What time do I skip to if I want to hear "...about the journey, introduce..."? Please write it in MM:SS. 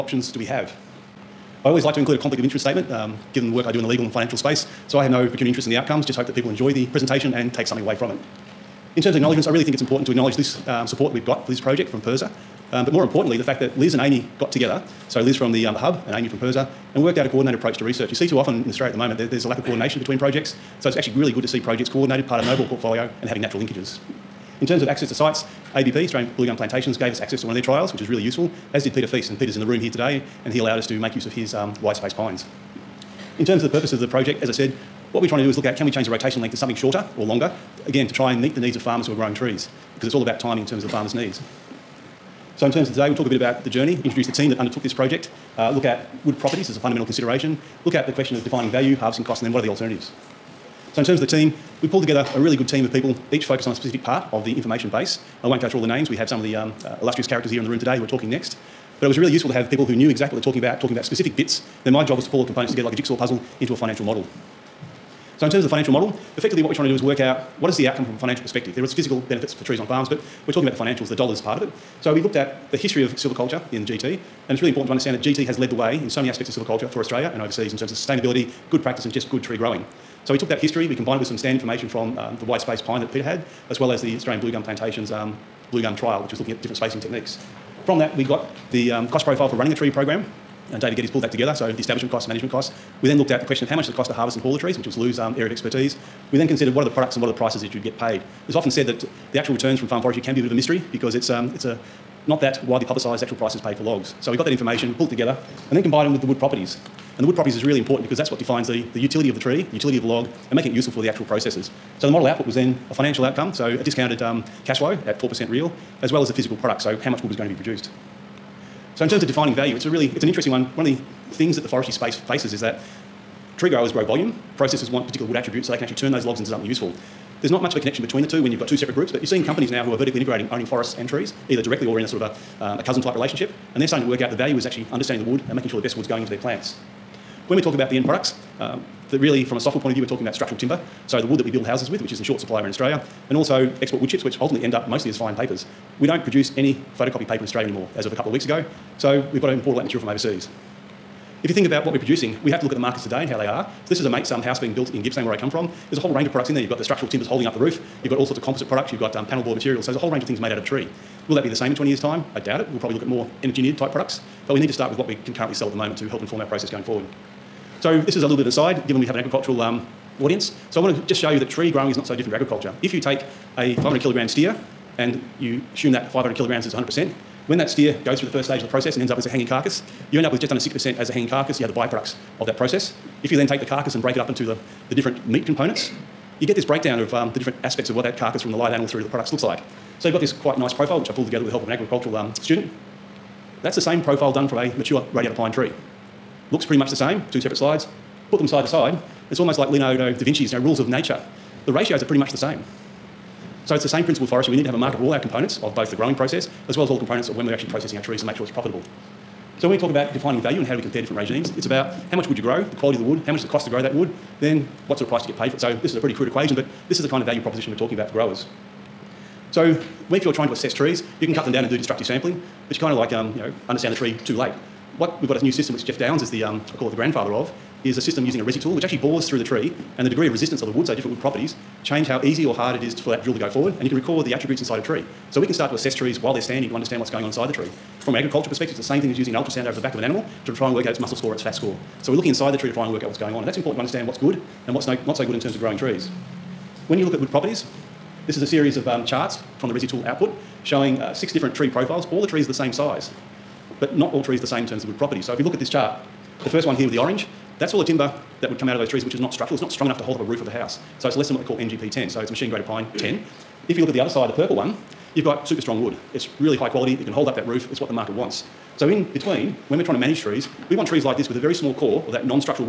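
00:43.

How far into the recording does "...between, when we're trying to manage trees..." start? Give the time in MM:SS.
04:29.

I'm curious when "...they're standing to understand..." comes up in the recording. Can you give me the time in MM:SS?
03:56.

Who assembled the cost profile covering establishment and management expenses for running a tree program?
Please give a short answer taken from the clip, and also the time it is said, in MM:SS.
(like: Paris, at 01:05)
David Geddes, at 01:30.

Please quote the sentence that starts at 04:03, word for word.
And that's important to understand what's good and what's no, not so good in terms of growing trees.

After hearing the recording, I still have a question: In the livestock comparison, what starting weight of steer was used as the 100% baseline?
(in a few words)
500 kilograms.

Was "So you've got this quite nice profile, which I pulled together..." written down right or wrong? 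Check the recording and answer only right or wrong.
right.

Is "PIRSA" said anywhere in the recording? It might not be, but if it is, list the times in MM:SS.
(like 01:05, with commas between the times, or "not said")
00:12, 00:16.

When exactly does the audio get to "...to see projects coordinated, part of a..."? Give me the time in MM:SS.
00:21.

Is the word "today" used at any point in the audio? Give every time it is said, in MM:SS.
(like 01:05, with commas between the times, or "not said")
00:29, 00:42, 00:57, 02:33.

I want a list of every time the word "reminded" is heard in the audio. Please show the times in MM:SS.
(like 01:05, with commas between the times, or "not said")
not said.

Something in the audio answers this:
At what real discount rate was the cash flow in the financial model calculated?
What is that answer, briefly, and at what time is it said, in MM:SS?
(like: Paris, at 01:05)
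4%, at 01:55.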